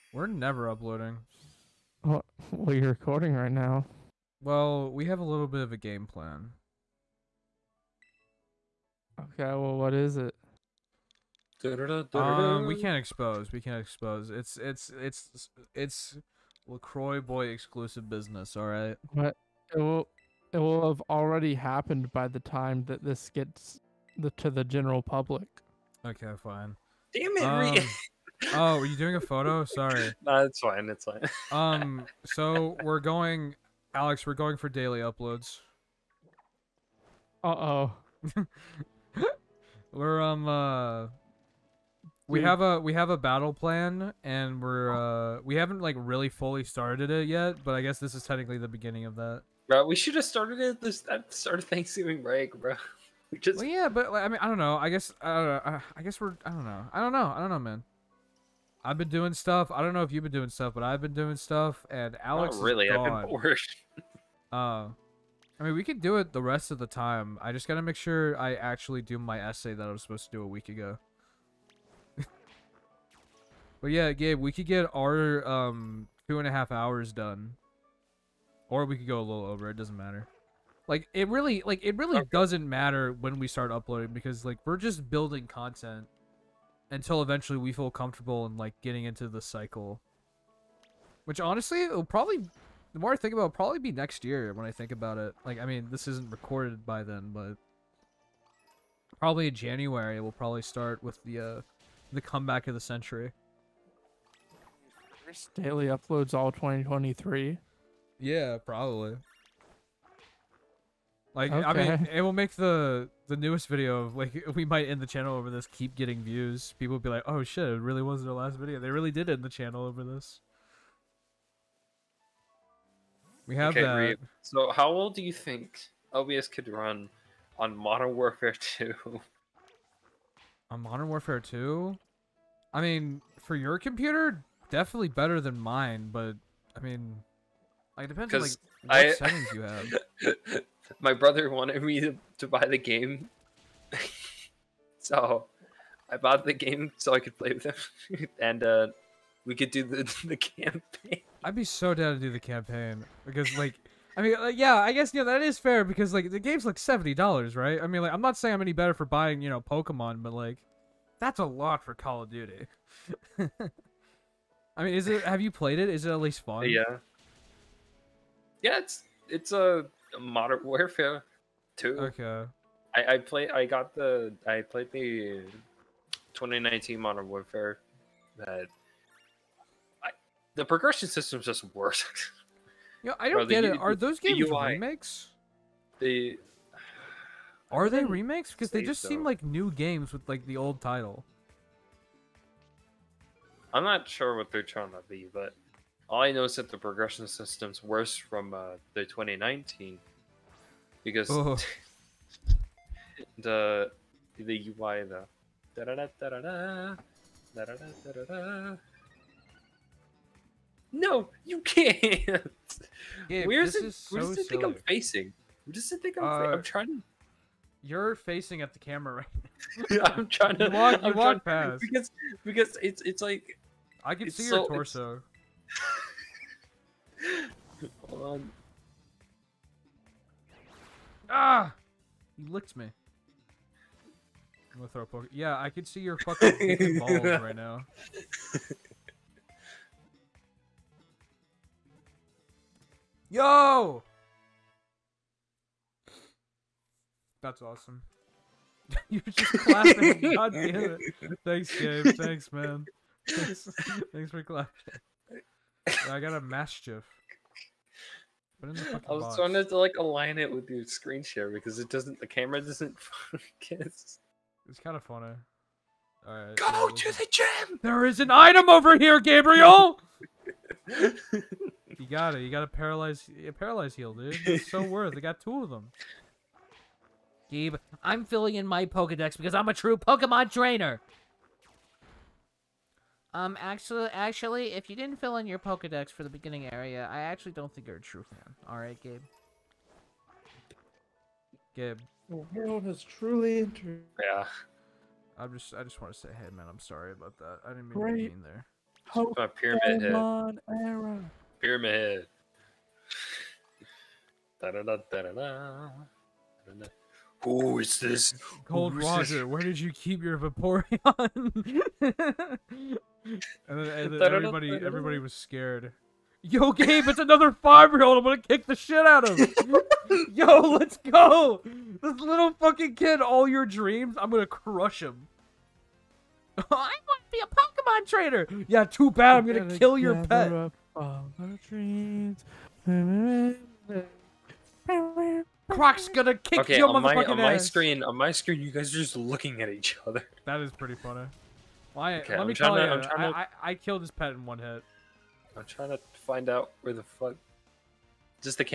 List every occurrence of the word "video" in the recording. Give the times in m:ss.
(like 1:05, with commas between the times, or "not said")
1:53, 1:58.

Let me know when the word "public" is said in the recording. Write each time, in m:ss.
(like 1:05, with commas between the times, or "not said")
0:25.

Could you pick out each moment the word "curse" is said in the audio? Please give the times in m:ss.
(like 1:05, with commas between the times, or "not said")
not said.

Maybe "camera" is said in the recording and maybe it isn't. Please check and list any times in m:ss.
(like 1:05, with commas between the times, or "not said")
3:38, 4:22.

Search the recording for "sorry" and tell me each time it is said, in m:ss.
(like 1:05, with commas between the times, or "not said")
0:29, 4:56.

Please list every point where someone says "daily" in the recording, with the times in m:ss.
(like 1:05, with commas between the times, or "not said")
0:34, 1:45.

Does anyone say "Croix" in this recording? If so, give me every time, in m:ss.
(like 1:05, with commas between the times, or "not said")
0:16.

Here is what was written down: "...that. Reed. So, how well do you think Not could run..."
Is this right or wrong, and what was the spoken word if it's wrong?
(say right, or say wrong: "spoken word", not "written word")
wrong: "OBS", not "Not".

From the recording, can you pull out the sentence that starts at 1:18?
Or we could go a little over, it doesn't matter.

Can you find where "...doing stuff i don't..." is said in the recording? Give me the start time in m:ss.
0:59.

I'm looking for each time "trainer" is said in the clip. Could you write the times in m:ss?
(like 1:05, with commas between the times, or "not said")
4:40, 5:28.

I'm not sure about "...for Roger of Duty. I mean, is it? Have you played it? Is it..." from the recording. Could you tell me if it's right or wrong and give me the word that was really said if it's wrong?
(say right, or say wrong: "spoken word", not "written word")
wrong: "Call", not "Roger".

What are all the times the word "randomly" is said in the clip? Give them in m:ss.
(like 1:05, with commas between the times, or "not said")
not said.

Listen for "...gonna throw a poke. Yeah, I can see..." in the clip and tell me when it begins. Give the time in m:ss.
3:54.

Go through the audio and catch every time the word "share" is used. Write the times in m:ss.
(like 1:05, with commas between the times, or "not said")
4:21.